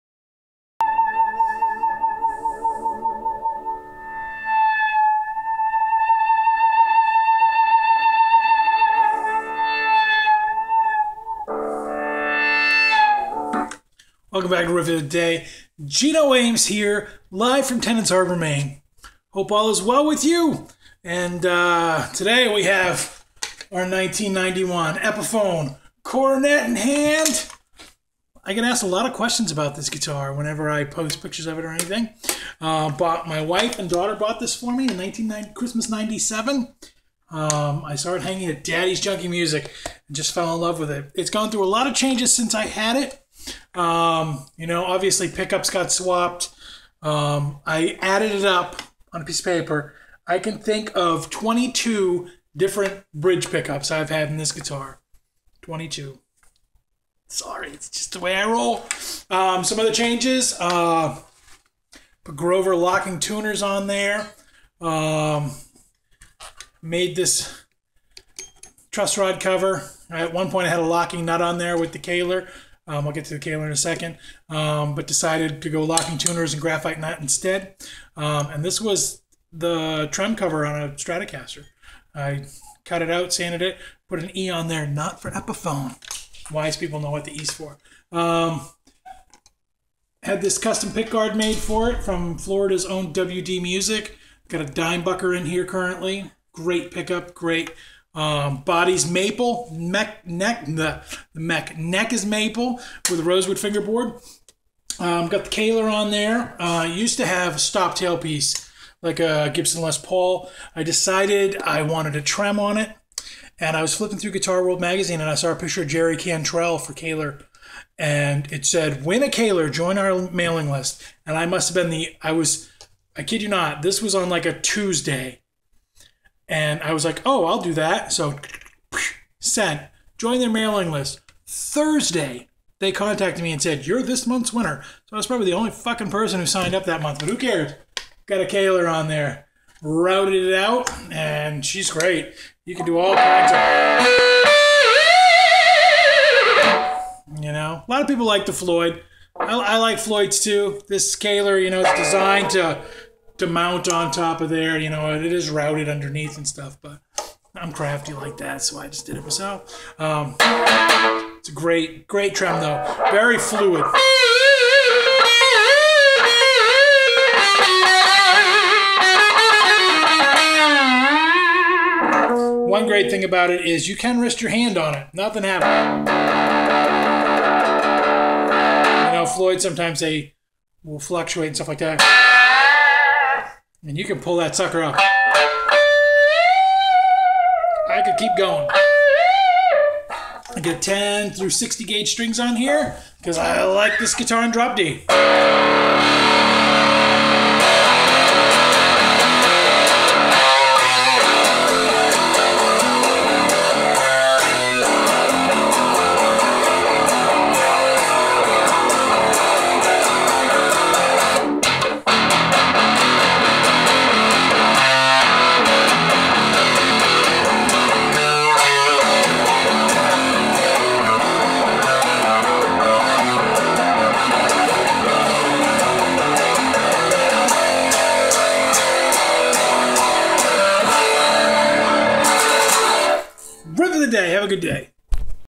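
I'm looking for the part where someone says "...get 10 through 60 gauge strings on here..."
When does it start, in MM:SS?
03:10.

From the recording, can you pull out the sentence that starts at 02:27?
You know, a lot of people like the Floyd.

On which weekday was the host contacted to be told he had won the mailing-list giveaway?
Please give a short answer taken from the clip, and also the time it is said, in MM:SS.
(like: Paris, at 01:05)
Thursday, at 02:11.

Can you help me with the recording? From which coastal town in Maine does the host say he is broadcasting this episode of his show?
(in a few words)
Tenants Harbor.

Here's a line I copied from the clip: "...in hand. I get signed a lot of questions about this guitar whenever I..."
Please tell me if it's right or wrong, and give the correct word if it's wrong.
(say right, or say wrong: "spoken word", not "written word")
wrong: "asked", not "signed".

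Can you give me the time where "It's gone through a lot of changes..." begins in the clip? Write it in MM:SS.
00:41.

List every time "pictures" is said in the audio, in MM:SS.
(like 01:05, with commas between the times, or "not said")
00:31, 01:55.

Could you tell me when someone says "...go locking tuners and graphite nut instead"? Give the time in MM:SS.
01:15.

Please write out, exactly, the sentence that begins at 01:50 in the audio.
I decided I wanted a trem on it.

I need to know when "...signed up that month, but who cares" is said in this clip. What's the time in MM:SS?
02:16.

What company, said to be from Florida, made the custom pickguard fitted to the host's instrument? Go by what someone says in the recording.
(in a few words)
WD Music.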